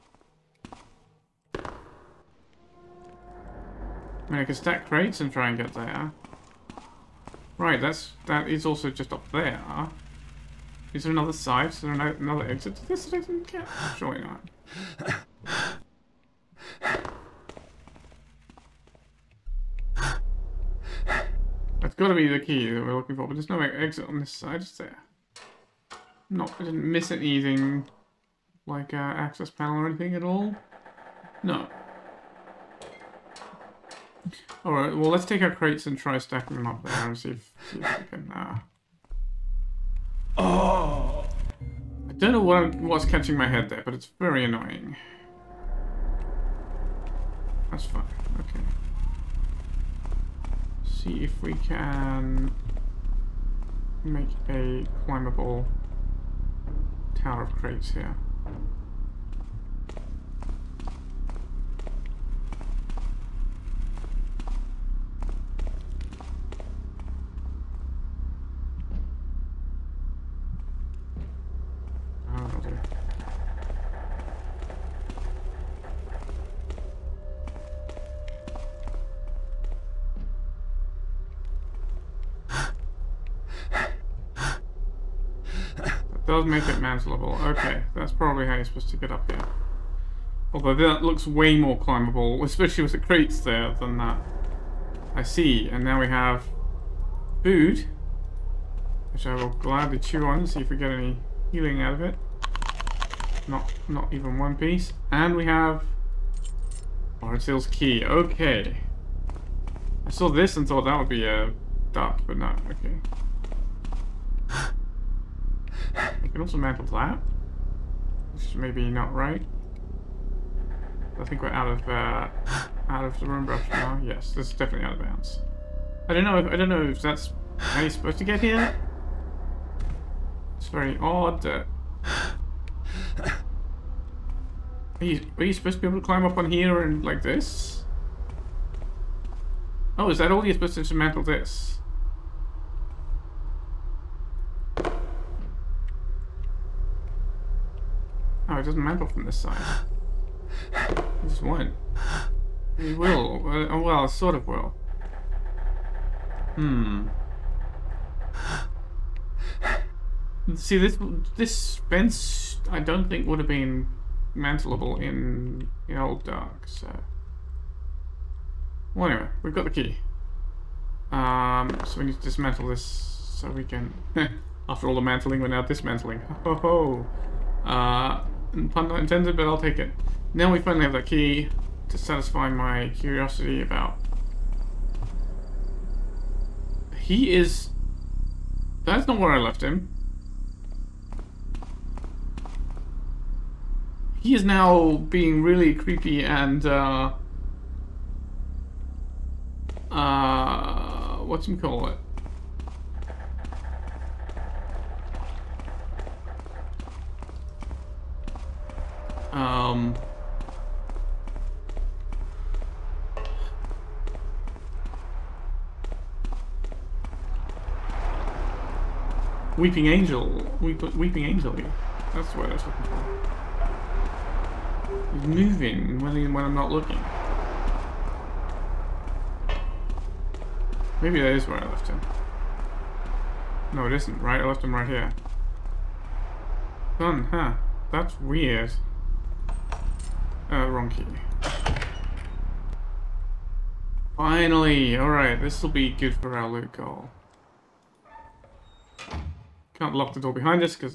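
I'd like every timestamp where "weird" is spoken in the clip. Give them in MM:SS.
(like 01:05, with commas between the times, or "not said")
03:58.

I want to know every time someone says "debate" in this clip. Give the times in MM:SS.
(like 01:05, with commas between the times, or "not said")
not said.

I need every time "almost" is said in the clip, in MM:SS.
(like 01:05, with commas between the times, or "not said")
not said.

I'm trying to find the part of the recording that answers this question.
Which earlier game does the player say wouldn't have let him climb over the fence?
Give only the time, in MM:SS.
02:45.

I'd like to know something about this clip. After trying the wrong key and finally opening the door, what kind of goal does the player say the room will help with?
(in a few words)
loot goal.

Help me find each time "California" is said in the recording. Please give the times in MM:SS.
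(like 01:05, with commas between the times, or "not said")
not said.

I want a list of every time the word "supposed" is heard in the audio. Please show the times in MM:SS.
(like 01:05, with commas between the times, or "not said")
01:28, 02:07, 02:15, 02:20.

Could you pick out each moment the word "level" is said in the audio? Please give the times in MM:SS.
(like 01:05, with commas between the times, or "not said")
01:27.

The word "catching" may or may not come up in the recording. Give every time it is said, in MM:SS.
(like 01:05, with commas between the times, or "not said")
00:43.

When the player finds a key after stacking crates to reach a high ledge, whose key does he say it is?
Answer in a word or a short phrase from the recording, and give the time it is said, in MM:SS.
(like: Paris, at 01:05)
Barnsale's key, at 01:47.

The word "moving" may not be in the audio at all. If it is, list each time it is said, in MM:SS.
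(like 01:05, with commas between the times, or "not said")
03:45.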